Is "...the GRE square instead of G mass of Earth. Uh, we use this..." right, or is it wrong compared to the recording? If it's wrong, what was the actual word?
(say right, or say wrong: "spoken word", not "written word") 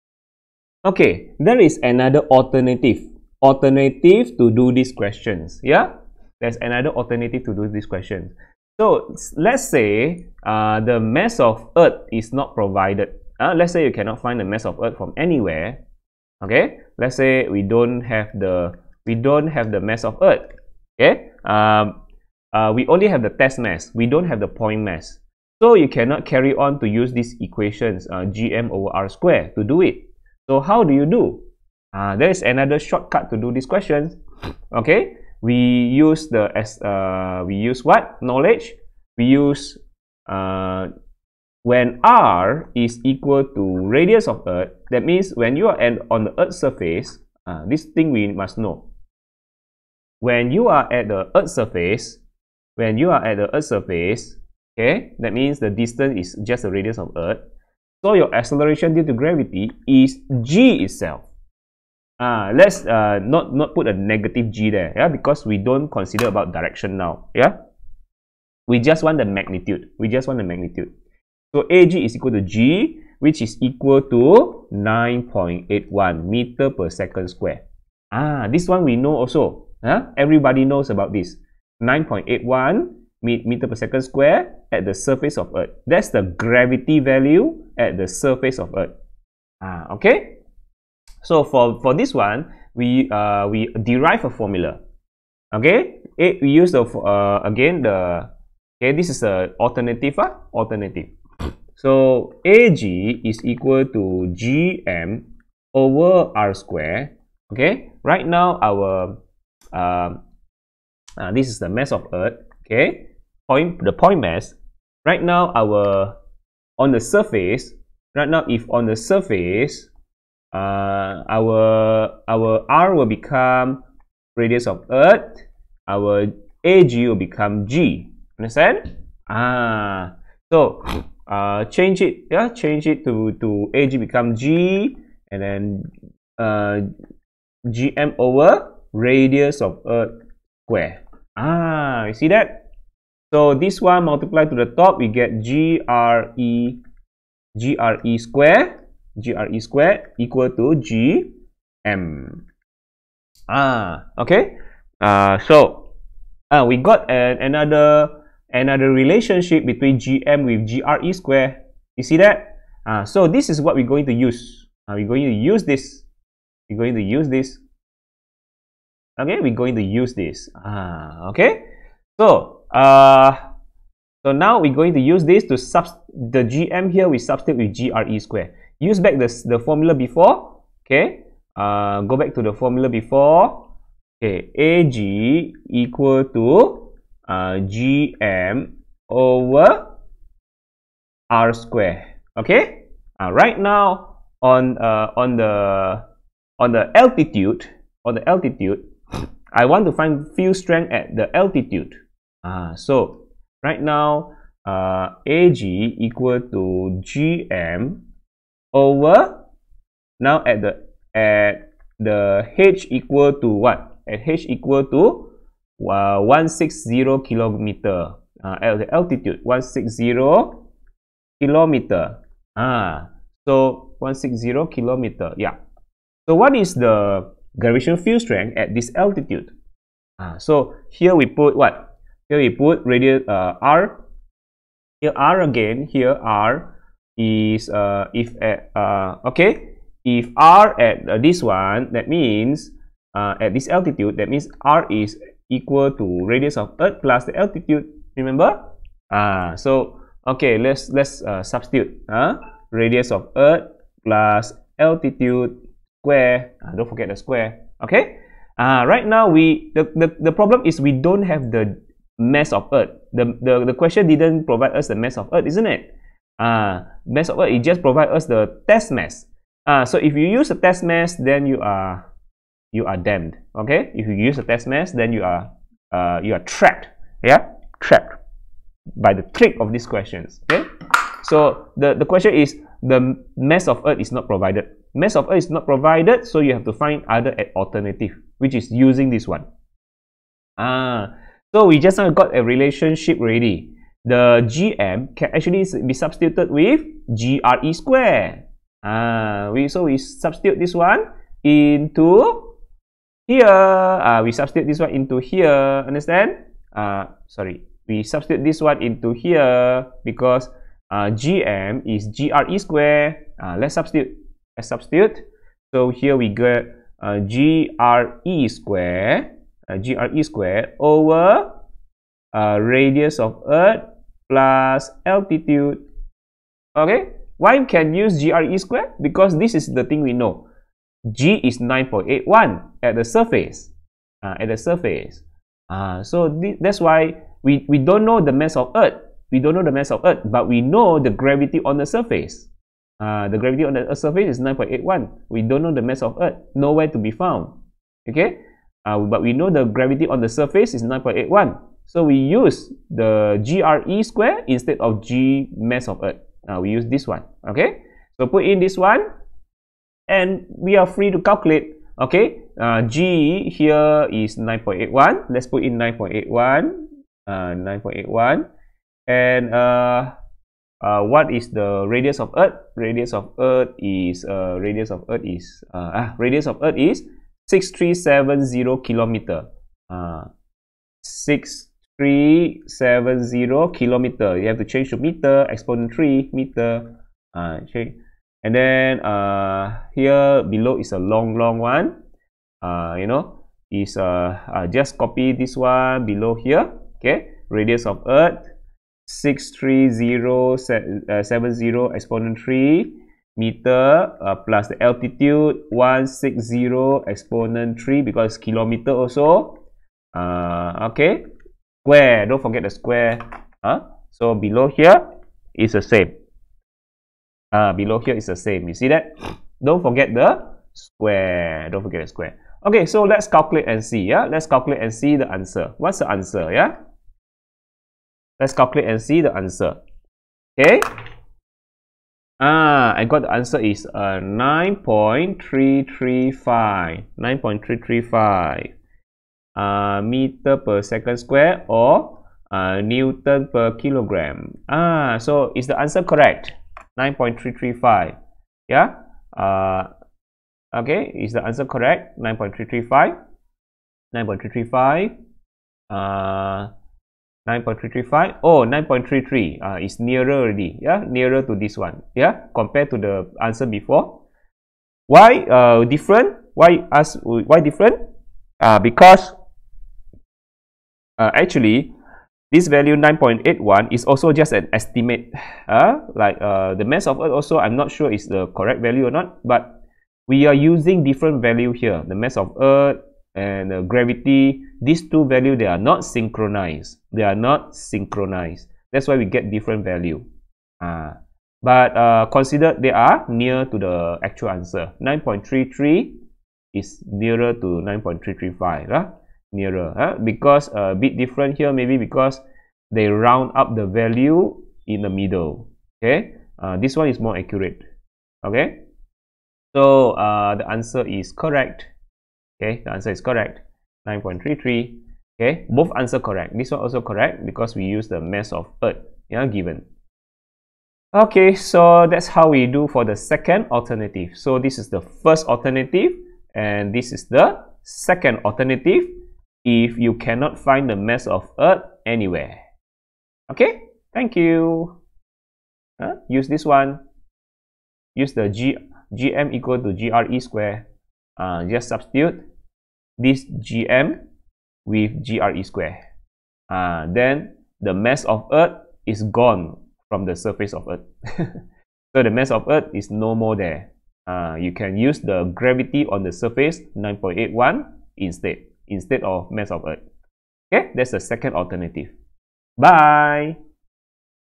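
right.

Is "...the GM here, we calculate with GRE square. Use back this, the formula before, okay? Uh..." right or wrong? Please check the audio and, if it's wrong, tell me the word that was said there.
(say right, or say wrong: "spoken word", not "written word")
wrong: "substitute", not "calculate".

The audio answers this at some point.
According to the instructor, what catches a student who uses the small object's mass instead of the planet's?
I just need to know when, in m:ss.
4:39.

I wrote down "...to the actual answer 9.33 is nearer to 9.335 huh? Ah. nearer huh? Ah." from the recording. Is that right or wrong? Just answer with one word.
right.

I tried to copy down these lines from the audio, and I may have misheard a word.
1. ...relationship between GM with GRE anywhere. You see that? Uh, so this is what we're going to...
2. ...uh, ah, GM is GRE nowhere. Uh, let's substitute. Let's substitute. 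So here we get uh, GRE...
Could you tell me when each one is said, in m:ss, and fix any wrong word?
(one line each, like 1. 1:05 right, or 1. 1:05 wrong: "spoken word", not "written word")
1. 2:38 wrong: "square", not "anywhere"
2. 5:10 wrong: "square", not "nowhere".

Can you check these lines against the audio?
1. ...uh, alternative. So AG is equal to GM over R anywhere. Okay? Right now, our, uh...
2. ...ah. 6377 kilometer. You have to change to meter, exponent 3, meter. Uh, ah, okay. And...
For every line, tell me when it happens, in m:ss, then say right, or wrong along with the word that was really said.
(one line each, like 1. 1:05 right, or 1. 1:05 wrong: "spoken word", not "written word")
1. 1:40 wrong: "square", not "anywhere"
2. 6:20 wrong: "6370", not "6377".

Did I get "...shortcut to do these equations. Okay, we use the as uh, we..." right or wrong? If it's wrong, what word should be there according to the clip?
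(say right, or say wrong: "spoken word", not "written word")
wrong: "questions", not "equations".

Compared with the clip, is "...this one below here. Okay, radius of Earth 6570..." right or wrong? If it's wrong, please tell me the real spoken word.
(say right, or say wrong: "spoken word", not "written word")
wrong: "6370", not "6570".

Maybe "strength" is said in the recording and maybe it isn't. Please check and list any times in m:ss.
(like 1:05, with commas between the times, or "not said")
3:20, 3:48.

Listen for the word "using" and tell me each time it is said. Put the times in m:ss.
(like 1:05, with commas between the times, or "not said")
4:48, 8:00.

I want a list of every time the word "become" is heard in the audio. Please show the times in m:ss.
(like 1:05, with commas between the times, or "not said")
2:03, 2:07, 2:13.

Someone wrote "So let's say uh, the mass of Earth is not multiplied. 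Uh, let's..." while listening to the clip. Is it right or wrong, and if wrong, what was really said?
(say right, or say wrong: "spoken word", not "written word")
wrong: "provided", not "multiplied".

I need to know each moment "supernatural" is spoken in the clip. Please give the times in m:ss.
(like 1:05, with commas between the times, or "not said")
not said.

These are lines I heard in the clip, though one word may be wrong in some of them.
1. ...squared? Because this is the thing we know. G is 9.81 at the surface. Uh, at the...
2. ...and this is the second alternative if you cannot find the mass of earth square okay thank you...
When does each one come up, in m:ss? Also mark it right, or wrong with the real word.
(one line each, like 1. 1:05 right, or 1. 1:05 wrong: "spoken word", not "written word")
1. 5:28 right
2. 8:46 wrong: "anywhere", not "square".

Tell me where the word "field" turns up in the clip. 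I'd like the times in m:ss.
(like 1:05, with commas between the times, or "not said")
3:20, 3:47.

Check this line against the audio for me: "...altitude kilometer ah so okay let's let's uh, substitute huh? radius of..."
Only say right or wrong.
wrong.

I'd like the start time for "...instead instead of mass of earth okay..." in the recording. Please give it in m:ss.
9:18.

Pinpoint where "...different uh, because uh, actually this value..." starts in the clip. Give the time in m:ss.
7:47.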